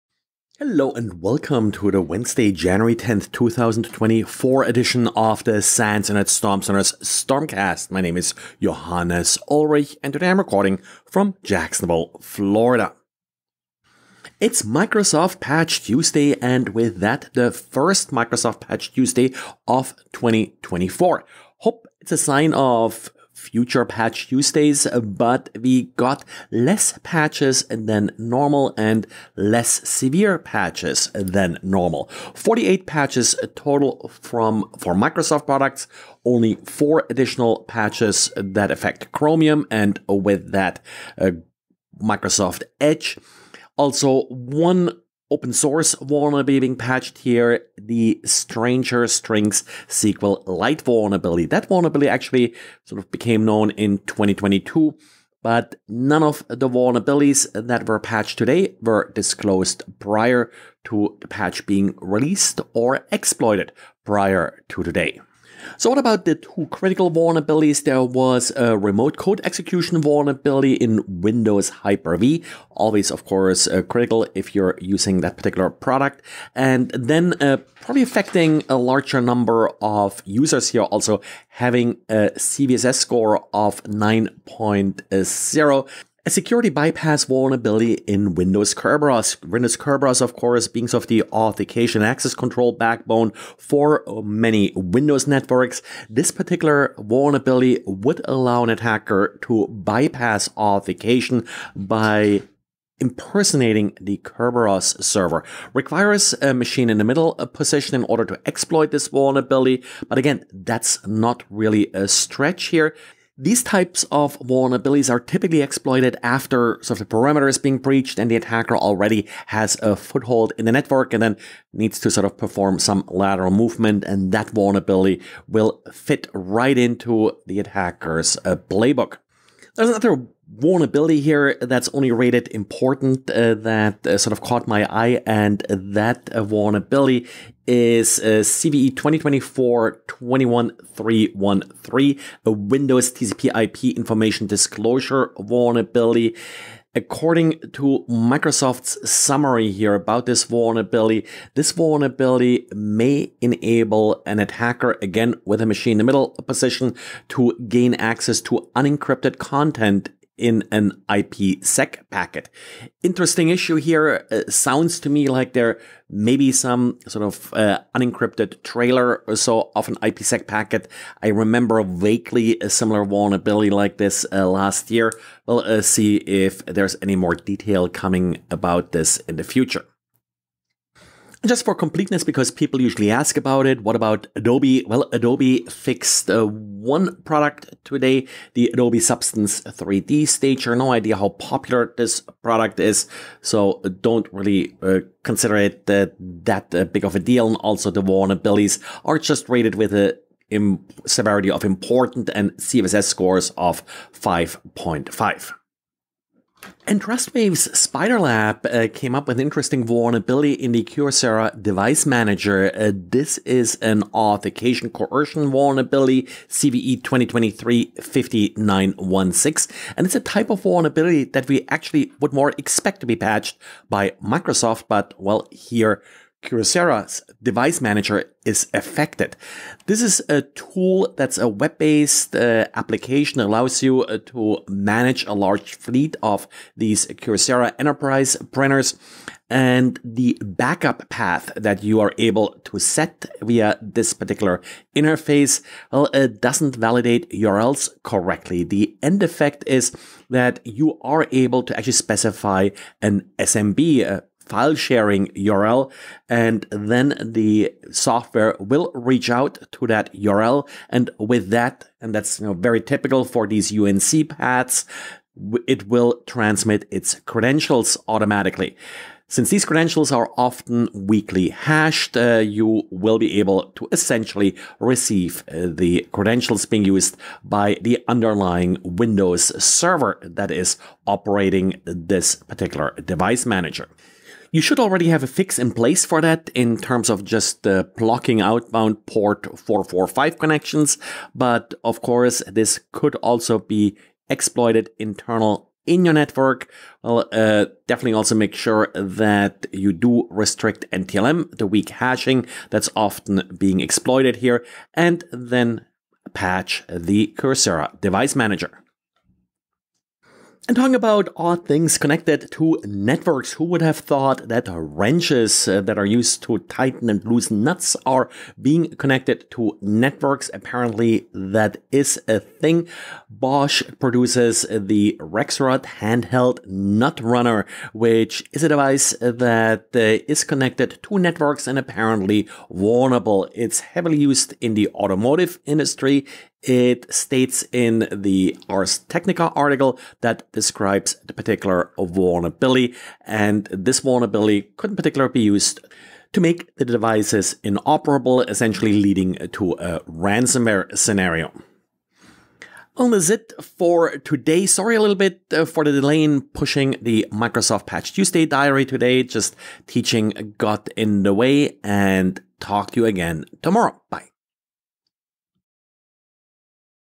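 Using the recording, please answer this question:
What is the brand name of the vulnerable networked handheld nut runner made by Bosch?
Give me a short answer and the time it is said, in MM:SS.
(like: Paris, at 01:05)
Rexroth, at 05:25.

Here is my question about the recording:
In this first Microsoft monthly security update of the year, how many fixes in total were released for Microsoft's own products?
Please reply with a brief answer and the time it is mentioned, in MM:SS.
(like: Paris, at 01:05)
48, at 00:32.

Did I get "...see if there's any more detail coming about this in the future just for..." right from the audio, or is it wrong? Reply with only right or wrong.
right.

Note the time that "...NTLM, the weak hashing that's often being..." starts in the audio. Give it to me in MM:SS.
05:00.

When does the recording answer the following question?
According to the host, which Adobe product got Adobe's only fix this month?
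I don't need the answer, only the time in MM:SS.
03:08.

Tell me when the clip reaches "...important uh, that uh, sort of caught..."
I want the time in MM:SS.
02:12.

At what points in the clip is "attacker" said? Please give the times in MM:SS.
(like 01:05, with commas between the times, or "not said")
01:38, 01:58, 02:07, 02:34.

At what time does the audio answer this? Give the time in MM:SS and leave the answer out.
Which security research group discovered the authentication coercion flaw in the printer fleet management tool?
03:27.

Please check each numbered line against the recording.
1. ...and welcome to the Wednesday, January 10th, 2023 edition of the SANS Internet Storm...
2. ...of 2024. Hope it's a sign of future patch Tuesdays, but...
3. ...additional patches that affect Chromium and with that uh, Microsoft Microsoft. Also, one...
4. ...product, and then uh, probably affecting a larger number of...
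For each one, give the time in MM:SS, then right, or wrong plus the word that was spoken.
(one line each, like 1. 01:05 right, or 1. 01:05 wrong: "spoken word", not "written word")
1. 00:00 wrong: "2024", not "2023"
2. 00:19 right
3. 00:37 wrong: "Edge", not "Microsoft"
4. 01:15 right.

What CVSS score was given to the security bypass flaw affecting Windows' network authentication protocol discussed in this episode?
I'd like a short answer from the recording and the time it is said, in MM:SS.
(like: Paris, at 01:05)
9.0, at 01:23.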